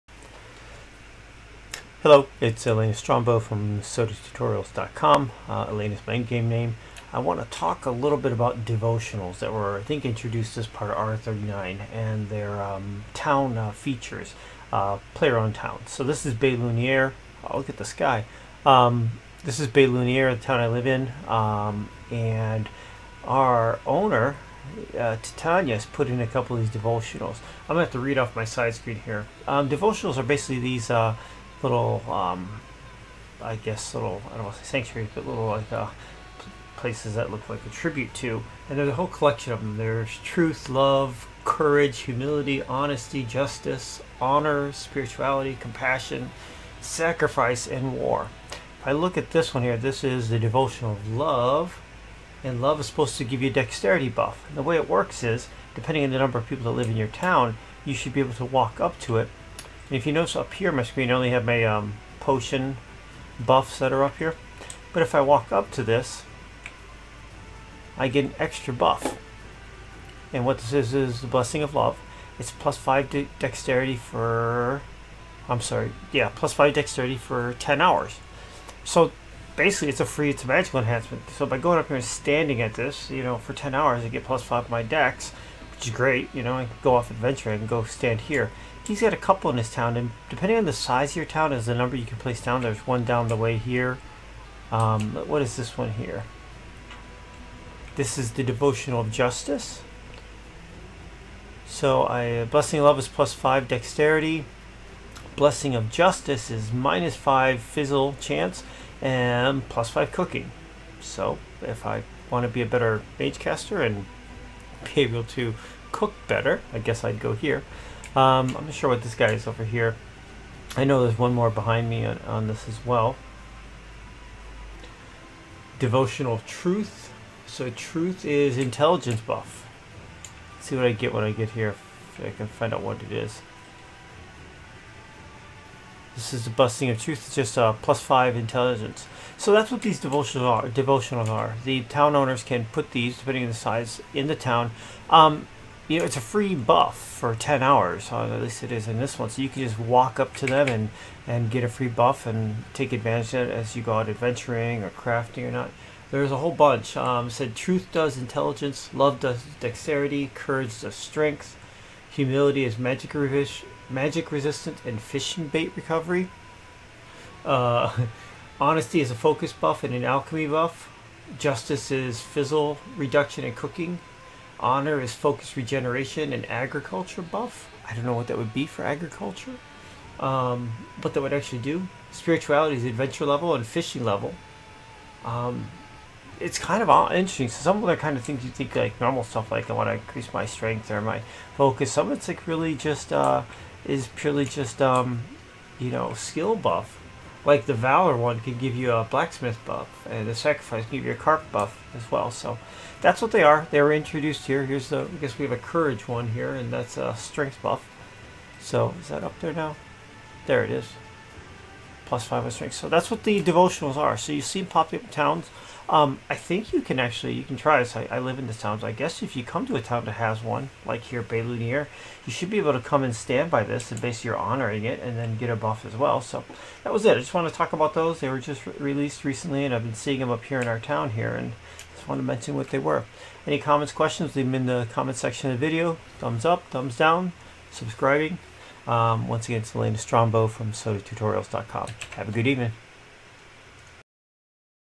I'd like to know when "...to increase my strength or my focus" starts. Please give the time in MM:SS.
03:09.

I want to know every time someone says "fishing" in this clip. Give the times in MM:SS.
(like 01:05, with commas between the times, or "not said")
02:45, 03:03.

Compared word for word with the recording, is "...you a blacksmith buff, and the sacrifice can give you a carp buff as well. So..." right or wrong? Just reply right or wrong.
right.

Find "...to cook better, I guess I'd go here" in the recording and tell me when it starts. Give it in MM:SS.
01:55.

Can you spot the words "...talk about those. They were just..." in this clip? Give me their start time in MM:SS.
03:47.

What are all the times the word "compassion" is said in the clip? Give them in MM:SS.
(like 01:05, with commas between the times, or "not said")
00:45.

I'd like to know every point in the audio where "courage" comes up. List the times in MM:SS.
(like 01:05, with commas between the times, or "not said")
00:41, 02:40, 03:25.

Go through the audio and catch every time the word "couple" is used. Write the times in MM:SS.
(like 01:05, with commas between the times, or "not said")
00:26, 01:29.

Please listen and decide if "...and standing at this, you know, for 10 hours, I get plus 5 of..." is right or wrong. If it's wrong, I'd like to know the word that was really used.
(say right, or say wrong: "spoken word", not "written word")
right.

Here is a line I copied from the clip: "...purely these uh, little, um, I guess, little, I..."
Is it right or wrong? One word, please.
wrong.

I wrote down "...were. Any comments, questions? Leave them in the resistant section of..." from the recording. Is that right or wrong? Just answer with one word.
wrong.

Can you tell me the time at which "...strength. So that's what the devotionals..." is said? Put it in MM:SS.
03:32.